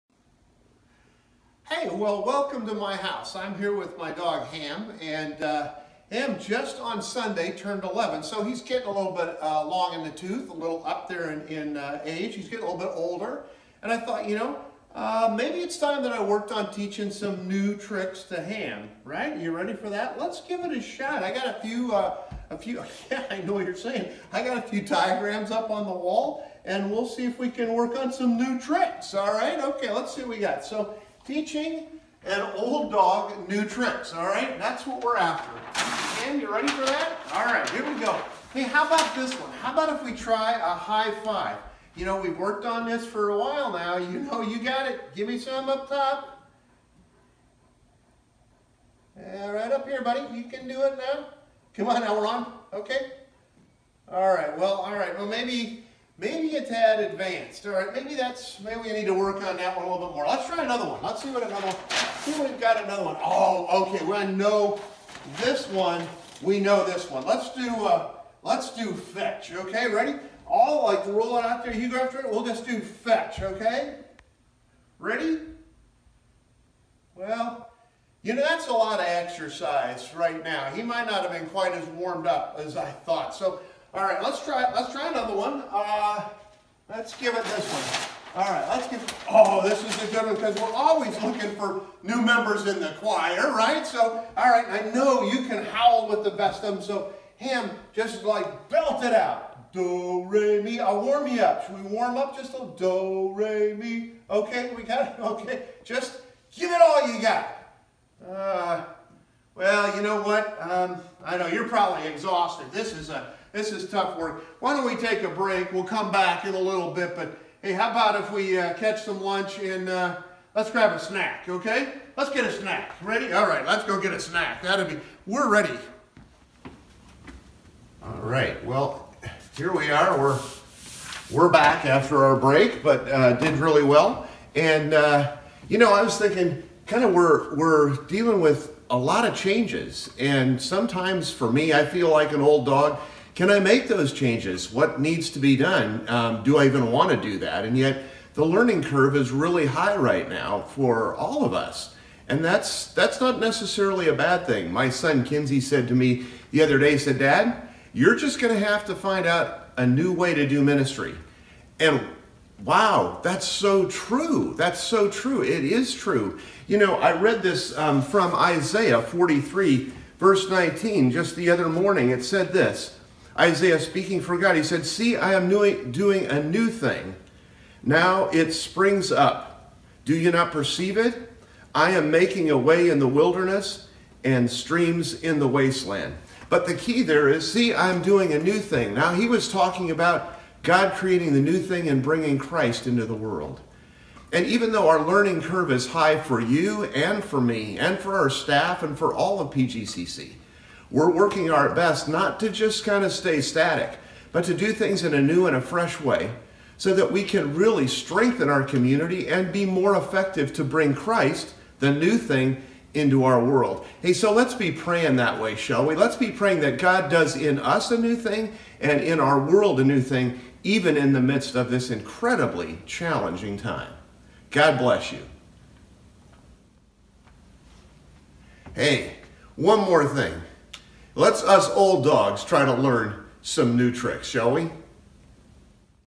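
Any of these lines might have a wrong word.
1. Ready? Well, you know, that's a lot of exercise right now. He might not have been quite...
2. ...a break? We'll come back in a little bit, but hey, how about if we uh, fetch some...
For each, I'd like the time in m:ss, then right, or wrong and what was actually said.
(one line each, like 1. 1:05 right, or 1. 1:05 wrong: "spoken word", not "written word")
1. 1:14 right
2. 1:55 wrong: "catch", not "fetch".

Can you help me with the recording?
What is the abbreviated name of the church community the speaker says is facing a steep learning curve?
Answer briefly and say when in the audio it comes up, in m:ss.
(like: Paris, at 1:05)
PGCC, at 3:19.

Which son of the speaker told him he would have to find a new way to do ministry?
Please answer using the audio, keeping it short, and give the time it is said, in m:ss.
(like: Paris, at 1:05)
Kinsey, at 2:35.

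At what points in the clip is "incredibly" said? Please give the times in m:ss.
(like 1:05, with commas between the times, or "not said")
3:41.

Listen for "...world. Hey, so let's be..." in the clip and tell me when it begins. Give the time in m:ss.
3:33.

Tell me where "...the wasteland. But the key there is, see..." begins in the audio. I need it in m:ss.
3:05.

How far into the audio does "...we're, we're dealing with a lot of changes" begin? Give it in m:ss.
2:17.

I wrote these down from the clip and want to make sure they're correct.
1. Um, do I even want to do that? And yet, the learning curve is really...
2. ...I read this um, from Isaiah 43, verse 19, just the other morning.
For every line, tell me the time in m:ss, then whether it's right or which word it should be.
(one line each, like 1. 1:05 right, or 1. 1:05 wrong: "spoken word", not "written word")
1. 2:26 right
2. 2:46 right.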